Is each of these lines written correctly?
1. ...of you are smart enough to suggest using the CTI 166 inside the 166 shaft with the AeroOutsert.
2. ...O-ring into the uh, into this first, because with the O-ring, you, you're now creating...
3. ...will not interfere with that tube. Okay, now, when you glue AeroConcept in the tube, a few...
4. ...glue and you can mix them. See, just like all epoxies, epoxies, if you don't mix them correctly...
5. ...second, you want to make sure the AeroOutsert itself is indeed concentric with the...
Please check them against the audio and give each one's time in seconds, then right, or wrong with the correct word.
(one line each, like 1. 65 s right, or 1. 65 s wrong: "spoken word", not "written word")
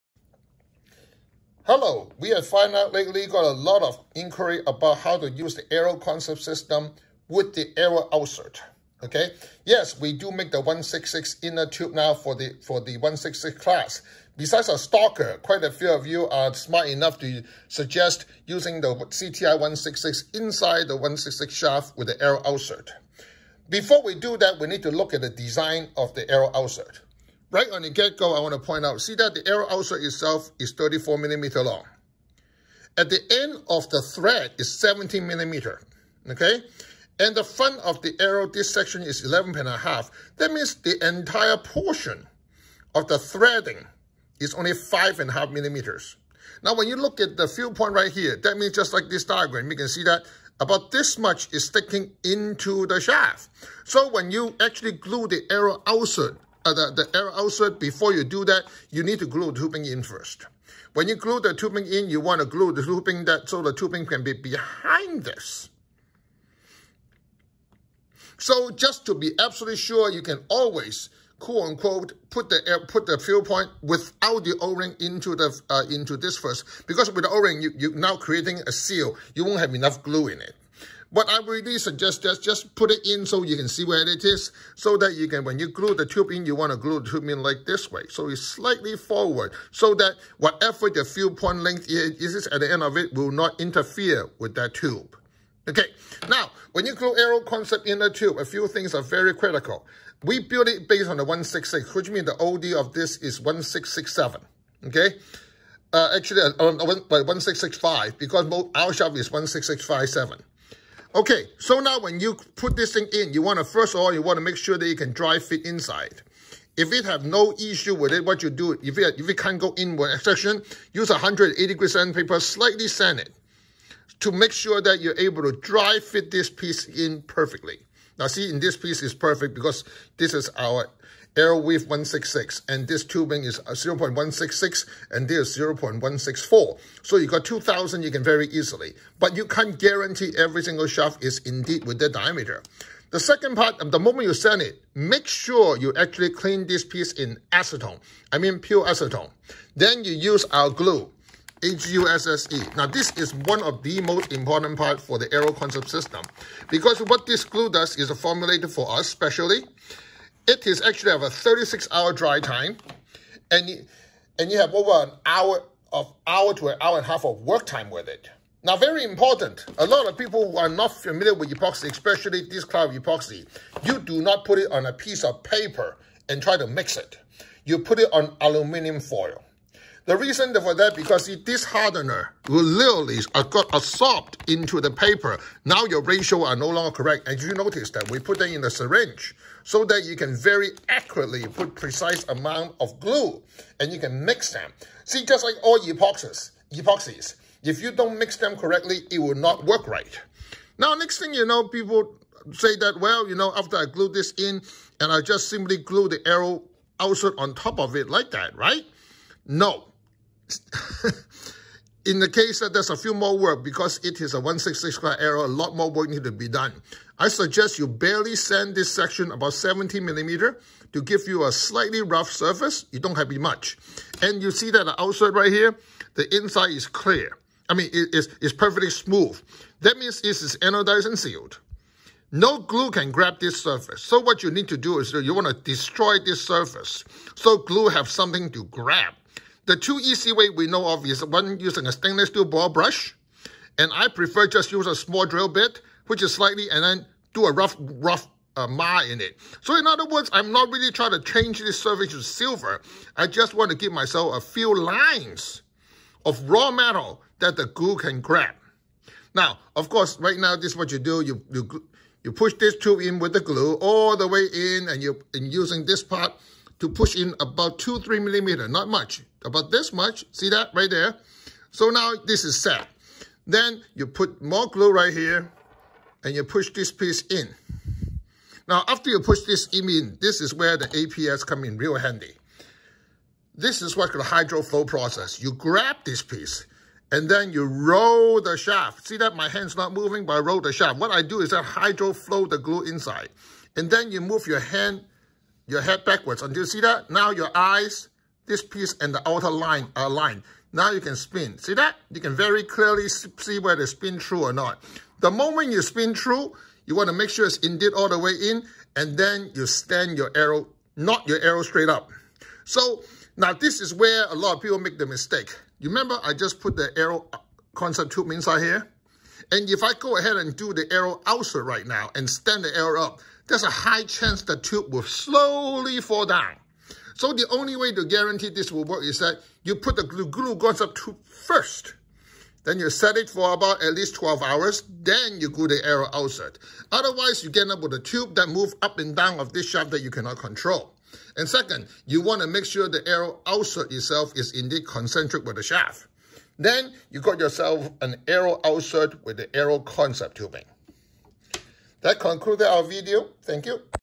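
1. 15 s right
2. 74 s right
3. 93 s right
4. 192 s right
5. 341 s right.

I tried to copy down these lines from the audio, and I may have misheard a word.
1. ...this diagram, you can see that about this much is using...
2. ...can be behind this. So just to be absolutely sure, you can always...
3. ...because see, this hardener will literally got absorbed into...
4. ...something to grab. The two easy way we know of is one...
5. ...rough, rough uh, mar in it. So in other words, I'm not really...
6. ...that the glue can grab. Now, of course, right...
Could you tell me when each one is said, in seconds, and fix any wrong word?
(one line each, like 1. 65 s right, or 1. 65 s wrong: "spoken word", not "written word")
1. 49 s wrong: "sticking", not "using"
2. 64 s right
3. 180 s right
4. 238 s right
5. 247 s right
6. 257 s right.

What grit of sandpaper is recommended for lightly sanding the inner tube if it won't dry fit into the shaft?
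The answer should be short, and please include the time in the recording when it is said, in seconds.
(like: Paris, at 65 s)
180, at 121 s.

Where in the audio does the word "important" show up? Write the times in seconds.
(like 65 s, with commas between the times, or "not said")
154 s, 169 s.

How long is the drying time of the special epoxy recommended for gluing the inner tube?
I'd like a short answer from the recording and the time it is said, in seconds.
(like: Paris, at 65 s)
36 hours, at 161 s.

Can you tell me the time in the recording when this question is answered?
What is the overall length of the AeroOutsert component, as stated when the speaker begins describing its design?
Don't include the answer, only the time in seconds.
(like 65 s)
30 s.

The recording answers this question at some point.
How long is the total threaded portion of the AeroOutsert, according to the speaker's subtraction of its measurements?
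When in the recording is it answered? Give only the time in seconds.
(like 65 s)
44 s.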